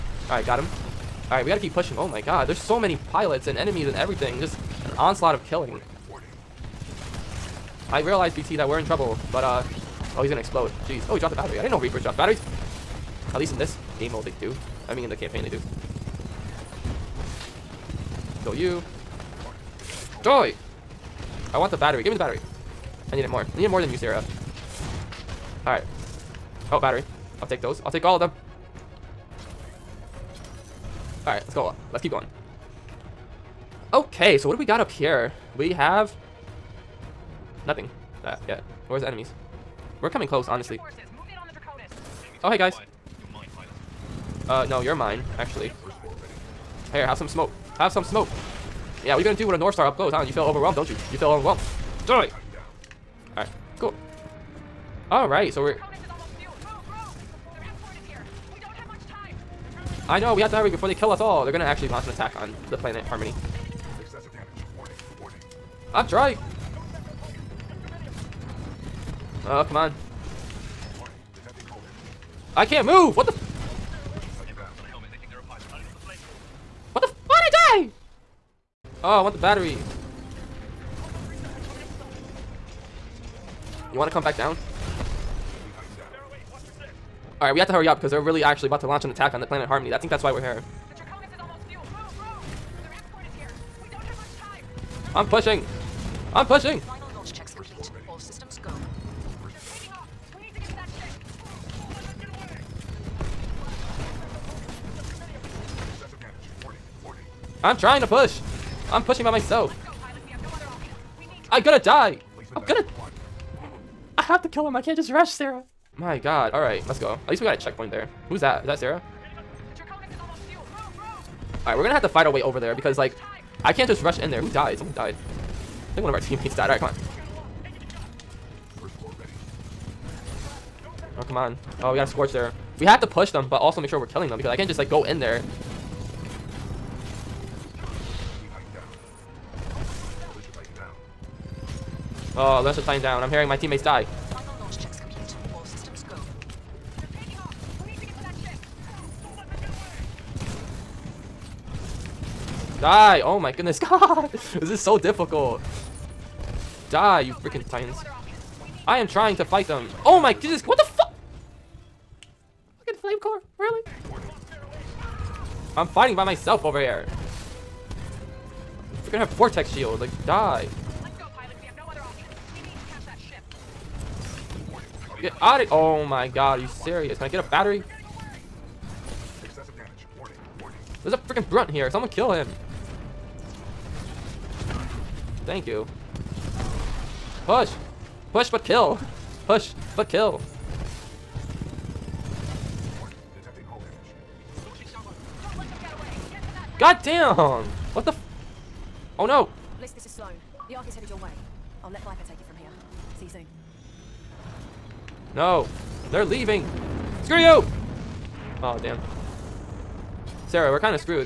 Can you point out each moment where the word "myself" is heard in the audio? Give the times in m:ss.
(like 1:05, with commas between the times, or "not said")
1:49, 2:46.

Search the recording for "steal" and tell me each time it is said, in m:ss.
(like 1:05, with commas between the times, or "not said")
not said.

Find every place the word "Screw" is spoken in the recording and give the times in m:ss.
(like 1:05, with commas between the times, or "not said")
3:27.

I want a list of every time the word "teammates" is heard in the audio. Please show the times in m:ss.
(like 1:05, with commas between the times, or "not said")
2:06, 2:23.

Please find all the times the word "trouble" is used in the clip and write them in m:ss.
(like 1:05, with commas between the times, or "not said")
0:08.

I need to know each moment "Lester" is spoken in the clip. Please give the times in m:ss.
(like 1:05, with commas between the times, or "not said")
2:22.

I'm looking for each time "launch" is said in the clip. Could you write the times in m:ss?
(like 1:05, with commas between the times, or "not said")
1:01, 1:28.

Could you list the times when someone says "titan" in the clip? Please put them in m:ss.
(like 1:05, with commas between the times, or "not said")
2:22, 2:37.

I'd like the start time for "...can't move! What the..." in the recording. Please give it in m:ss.
1:12.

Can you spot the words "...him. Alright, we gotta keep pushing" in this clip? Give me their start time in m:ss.
0:00.